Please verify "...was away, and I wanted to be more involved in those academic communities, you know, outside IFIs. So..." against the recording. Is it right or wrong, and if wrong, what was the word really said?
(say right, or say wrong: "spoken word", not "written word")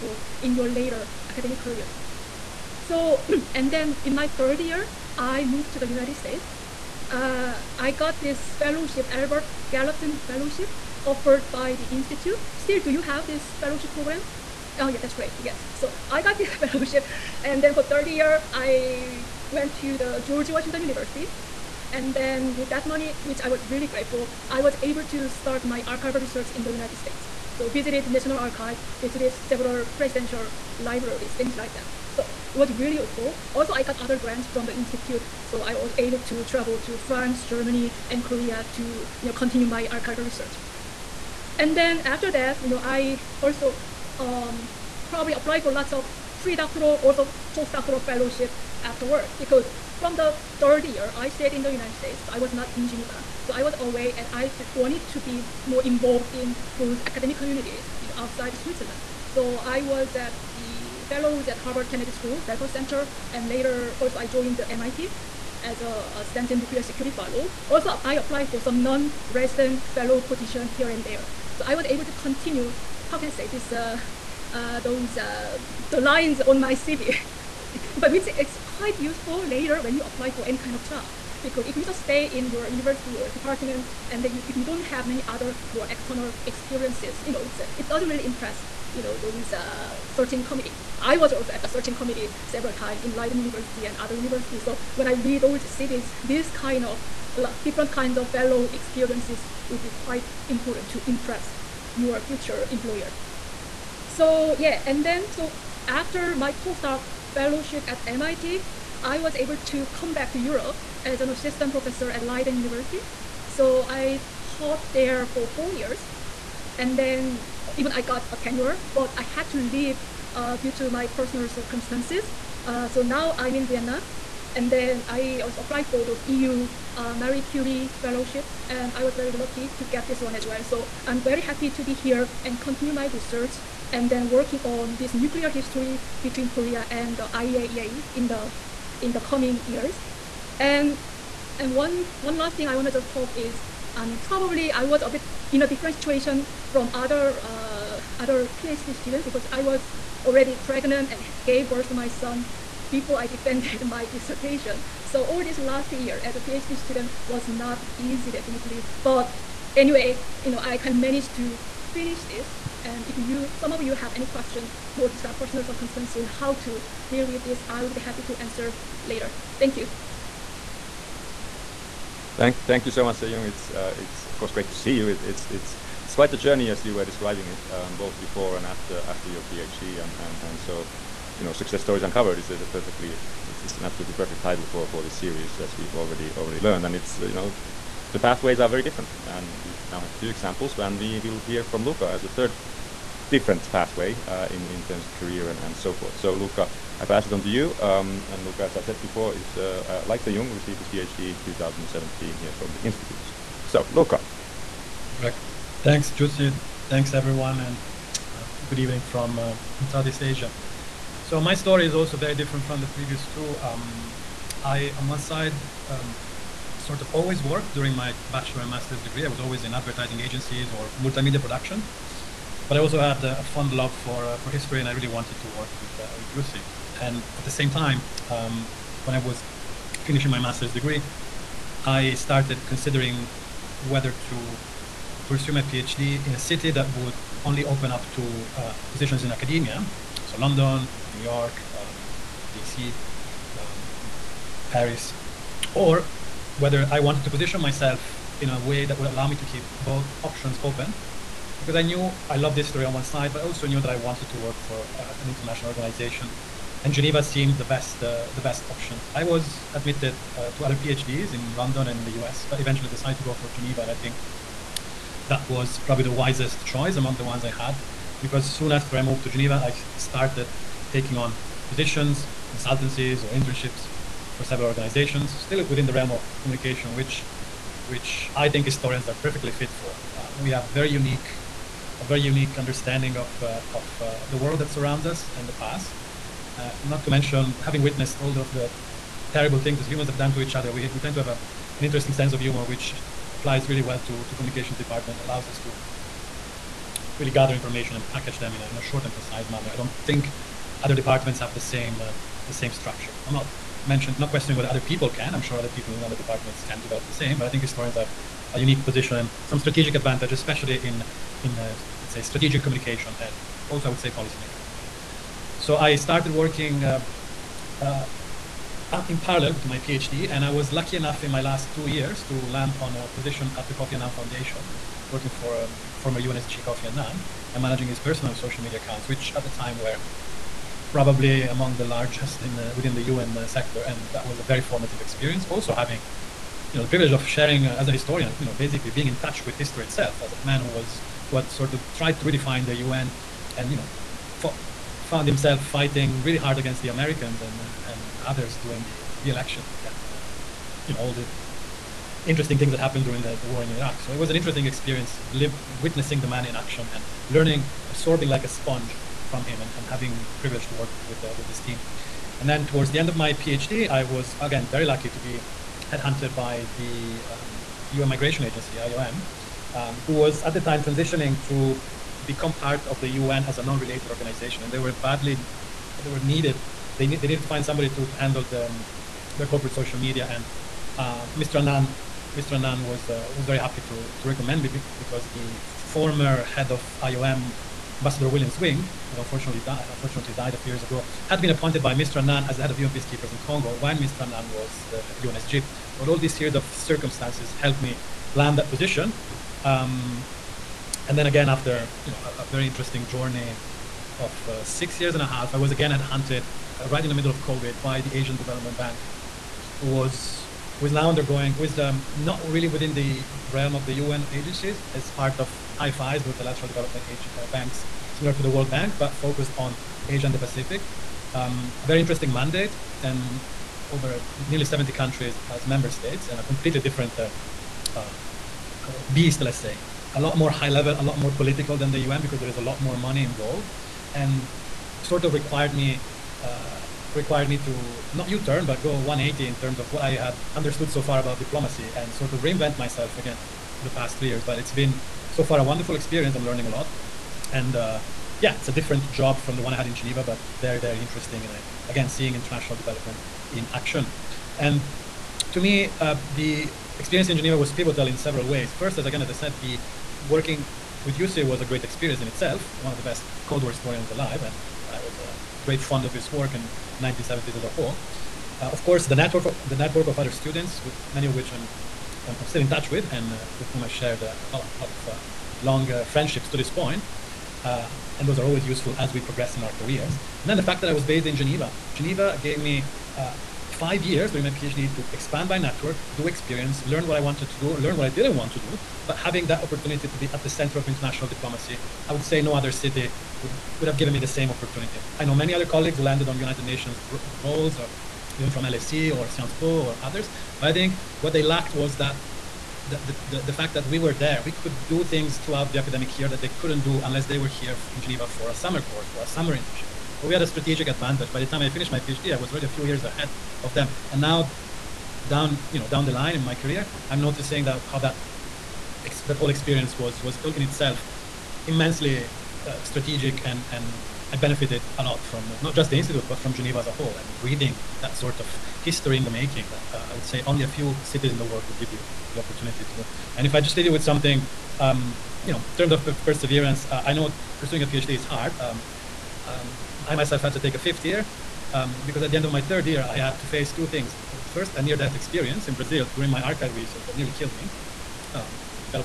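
wrong: "Switzerland", not "IFIs".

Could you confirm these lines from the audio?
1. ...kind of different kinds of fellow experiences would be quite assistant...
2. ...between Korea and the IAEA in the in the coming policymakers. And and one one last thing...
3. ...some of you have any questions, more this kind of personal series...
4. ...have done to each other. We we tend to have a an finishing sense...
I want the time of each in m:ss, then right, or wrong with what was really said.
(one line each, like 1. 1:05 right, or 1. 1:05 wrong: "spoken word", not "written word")
1. 1:36 wrong: "important", not "assistant"
2. 2:16 wrong: "years", not "policymakers"
3. 2:43 wrong: "circumstances", not "series"
4. 4:50 wrong: "interesting", not "finishing".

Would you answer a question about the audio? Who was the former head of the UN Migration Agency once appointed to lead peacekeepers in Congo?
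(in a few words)
William Swing.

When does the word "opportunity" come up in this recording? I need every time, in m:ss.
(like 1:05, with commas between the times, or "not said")
8:09, 8:14, 8:52.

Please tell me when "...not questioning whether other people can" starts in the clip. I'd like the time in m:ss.
5:04.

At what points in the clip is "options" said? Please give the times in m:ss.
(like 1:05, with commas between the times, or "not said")
4:10, 4:18.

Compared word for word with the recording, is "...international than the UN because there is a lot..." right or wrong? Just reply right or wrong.
wrong.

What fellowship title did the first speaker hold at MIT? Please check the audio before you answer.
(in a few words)
Stanton Nuclear Security Fellow.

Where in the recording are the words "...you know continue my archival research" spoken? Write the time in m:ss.
0:39.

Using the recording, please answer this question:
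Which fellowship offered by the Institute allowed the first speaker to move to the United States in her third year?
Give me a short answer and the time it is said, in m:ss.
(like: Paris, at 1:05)
Albert Gallatin Fellowship, at 0:09.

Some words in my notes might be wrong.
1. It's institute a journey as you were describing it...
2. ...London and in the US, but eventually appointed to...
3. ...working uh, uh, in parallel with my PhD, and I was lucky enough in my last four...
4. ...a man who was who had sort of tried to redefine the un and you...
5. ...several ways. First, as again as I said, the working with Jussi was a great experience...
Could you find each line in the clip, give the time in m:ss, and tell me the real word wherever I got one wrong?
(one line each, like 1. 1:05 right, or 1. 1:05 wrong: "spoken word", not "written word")
1. 2:55 wrong: "quite", not "institute"
2. 4:21 wrong: "decided", not "appointed"
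3. 5:16 wrong: "two", not "four"
4. 5:40 right
5. 7:38 right.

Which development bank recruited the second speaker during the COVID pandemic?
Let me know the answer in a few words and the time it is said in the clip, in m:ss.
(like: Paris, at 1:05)
Asian Development Bank, at 6:48.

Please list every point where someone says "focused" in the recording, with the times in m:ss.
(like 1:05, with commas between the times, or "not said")
6:59.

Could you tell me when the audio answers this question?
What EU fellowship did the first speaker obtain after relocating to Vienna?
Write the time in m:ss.
2:07.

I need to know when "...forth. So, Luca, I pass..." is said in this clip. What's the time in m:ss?
3:15.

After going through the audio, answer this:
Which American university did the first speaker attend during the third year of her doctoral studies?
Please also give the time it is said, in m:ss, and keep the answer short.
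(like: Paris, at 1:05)
George Washington University, at 0:20.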